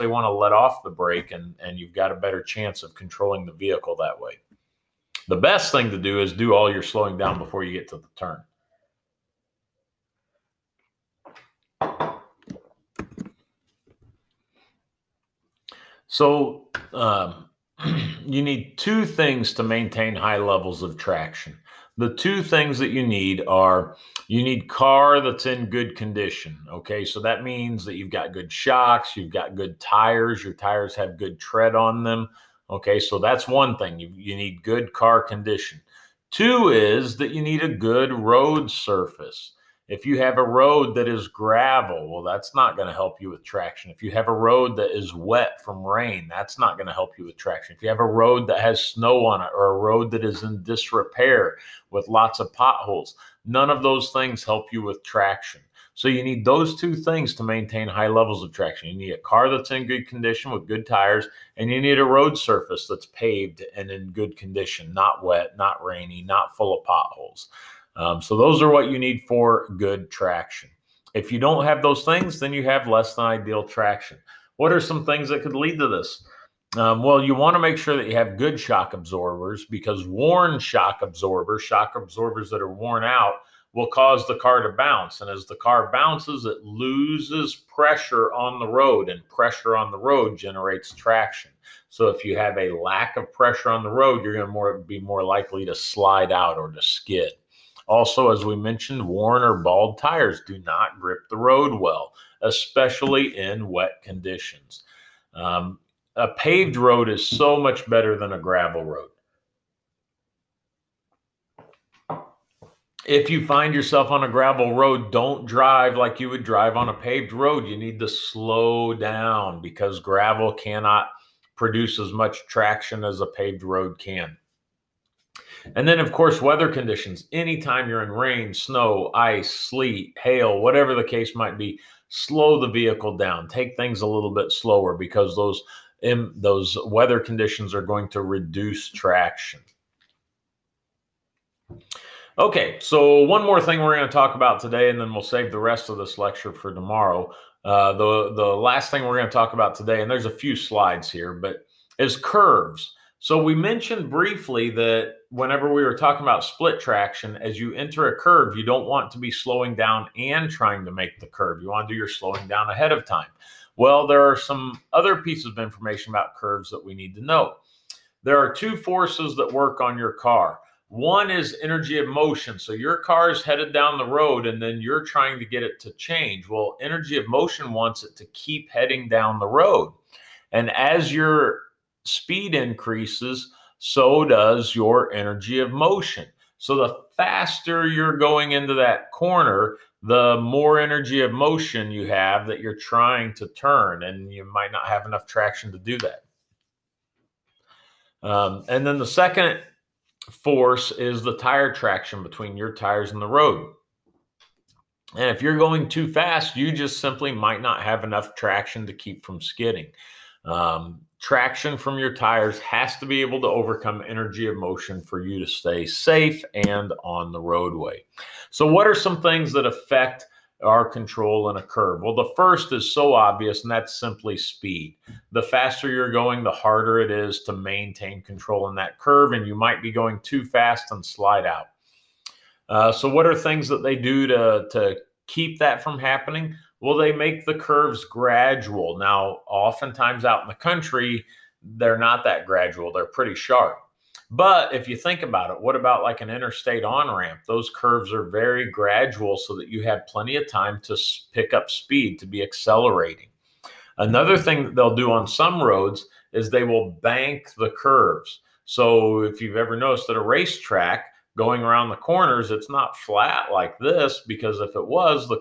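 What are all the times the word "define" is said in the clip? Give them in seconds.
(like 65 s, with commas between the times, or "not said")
not said.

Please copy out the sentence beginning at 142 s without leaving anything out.
Okay, so one more thing we're going to talk about today, and then we'll save the rest of this lecture for tomorrow.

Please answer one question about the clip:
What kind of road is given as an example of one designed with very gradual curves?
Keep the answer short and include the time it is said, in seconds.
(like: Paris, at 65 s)
Interstate on ramp, at 246 s.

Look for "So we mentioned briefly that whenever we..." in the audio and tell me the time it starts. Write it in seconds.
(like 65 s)
153 s.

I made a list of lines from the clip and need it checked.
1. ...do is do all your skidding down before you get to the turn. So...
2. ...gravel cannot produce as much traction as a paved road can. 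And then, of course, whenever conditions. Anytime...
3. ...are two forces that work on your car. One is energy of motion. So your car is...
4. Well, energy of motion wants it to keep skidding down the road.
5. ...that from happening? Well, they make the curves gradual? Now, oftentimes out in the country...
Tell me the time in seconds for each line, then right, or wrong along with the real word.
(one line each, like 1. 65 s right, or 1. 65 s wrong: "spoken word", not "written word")
1. 5 s wrong: "slowing", not "skidding"
2. 119 s wrong: "weather", not "whenever"
3. 168 s right
4. 176 s wrong: "heading", not "skidding"
5. 235 s right.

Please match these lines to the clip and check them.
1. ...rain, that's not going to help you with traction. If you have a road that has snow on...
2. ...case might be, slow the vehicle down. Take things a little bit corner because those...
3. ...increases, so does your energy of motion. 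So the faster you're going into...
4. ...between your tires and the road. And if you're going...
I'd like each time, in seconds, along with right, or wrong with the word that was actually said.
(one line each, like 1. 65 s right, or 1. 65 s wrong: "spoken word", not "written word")
1. 45 s right
2. 131 s wrong: "slower", not "corner"
3. 182 s right
4. 202 s right.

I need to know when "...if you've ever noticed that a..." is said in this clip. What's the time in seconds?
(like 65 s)
259 s.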